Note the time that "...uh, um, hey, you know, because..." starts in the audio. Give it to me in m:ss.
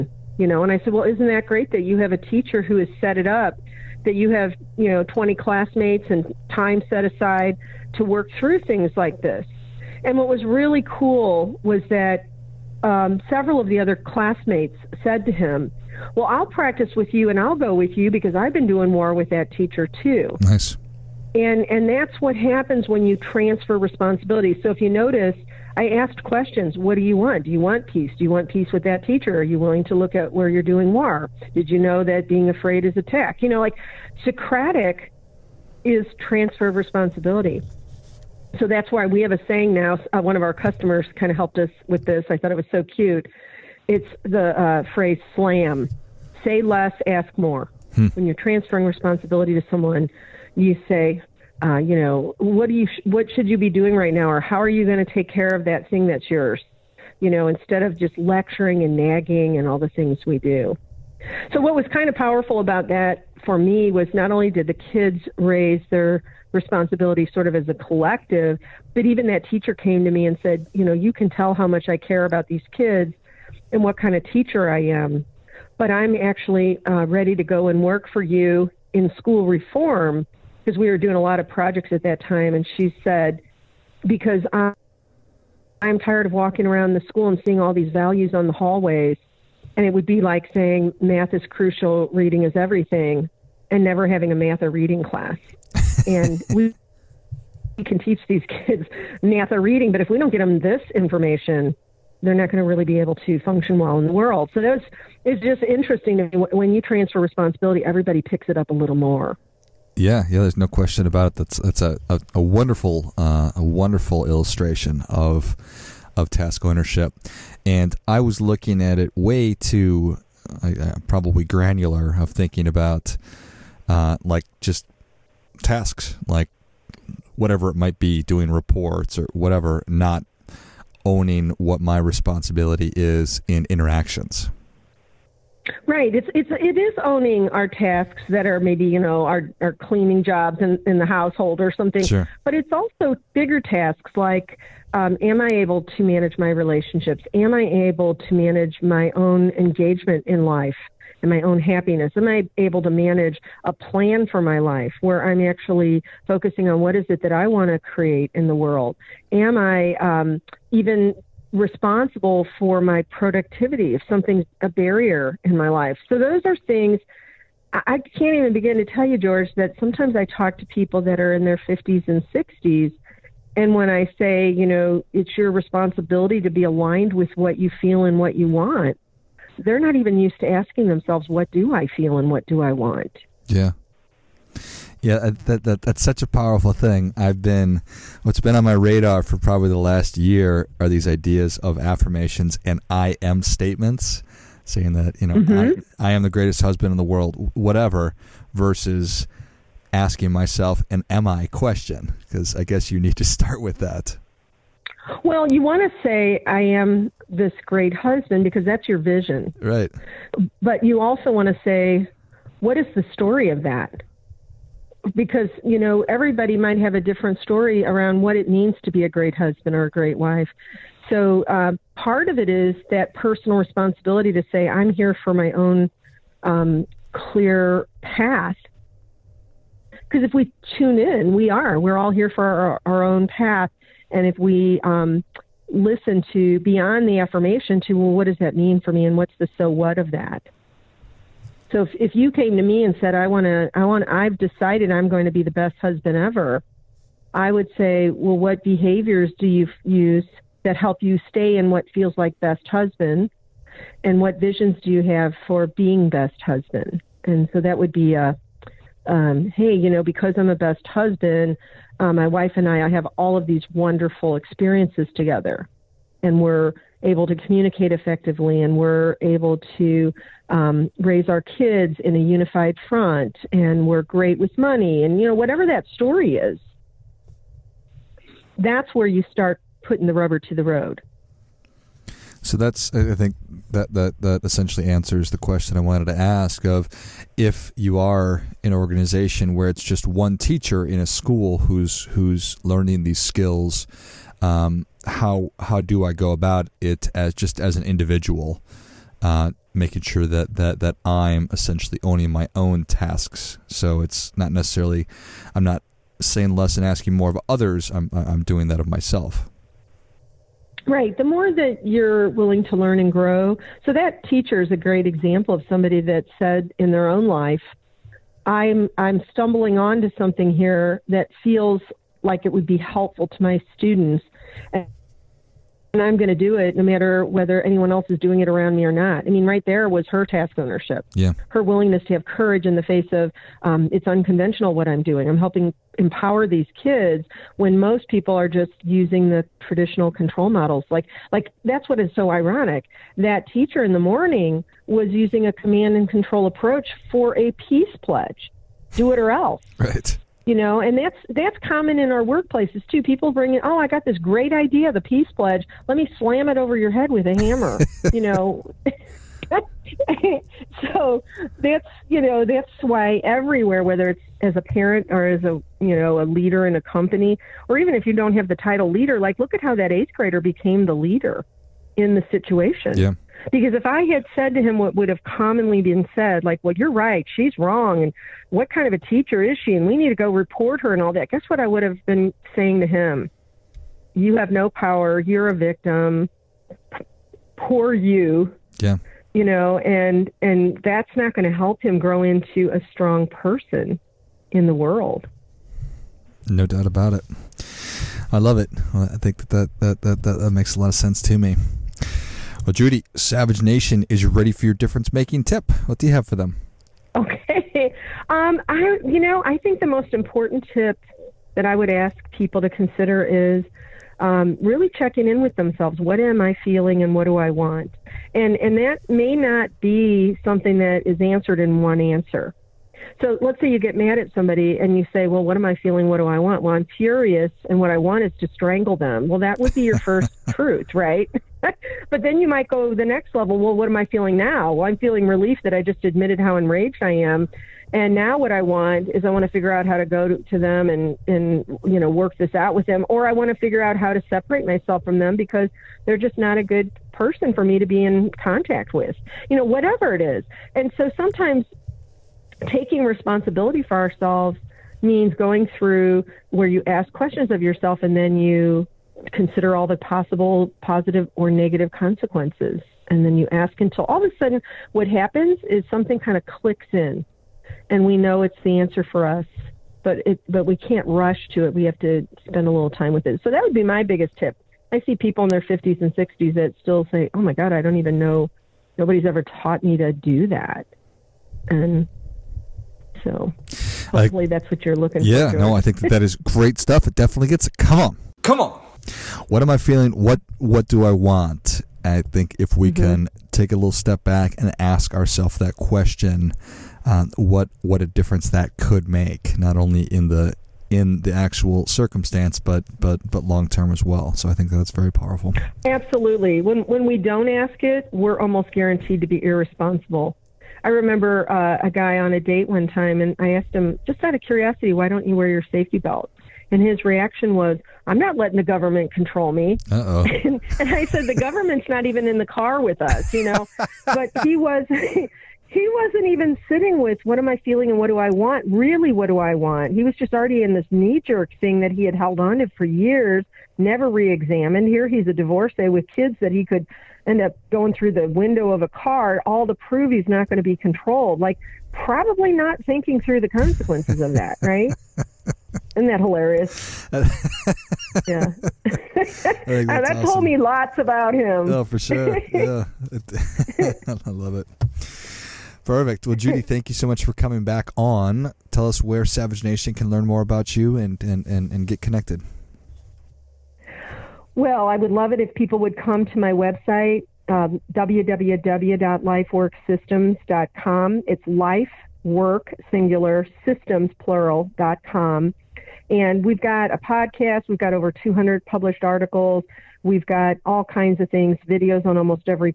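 4:18.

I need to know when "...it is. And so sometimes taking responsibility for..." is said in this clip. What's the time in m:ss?
7:30.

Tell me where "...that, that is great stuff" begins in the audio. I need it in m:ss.
8:06.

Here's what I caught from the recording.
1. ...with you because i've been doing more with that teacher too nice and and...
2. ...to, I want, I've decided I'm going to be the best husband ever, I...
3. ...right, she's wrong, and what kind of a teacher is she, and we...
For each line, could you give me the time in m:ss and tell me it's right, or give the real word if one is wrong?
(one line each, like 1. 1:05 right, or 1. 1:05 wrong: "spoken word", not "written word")
1. 0:17 right
2. 4:03 right
3. 6:16 right.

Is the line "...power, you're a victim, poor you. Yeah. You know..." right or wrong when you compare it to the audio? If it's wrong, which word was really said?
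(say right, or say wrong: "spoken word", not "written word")
right.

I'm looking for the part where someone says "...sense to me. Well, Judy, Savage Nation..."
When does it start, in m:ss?
6:40.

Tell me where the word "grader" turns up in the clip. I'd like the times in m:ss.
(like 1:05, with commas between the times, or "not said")
6:10.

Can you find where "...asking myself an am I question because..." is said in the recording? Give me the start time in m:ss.
3:19.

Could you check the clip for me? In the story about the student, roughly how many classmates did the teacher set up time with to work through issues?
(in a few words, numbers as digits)
20.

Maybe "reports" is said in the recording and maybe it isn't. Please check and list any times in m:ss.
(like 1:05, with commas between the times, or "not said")
2:08, 6:20.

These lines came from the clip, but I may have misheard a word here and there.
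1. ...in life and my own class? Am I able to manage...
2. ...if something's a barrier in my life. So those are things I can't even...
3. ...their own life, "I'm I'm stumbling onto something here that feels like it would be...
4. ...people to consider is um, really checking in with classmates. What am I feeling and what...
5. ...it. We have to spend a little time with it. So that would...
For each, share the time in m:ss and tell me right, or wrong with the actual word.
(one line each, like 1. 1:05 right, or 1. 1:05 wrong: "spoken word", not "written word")
1. 2:30 wrong: "happiness", not "class"
2. 2:43 right
3. 5:16 right
4. 6:52 wrong: "themselves", not "classmates"
5. 7:51 right.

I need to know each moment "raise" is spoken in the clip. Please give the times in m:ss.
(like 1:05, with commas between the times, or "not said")
1:05, 4:30.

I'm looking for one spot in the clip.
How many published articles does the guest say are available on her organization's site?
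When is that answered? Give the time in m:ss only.
9:37.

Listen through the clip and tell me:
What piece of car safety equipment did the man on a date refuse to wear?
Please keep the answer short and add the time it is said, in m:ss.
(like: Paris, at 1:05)
safety belt, at 8:35.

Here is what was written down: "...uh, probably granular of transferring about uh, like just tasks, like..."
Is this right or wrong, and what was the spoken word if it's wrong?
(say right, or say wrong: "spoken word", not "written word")
wrong: "thinking", not "transferring".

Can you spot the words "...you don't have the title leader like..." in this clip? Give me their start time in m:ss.
6:08.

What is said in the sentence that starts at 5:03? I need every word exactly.
So it's not necessarily I'm not saying less and asking more of others.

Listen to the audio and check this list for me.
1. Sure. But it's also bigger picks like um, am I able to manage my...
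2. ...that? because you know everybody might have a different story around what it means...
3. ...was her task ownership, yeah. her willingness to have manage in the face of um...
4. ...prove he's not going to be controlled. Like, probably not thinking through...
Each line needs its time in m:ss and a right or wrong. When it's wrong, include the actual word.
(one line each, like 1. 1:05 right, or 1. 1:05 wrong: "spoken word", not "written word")
1. 2:22 wrong: "tasks", not "picks"
2. 3:33 right
3. 5:29 wrong: "courage", not "manage"
4. 8:59 right.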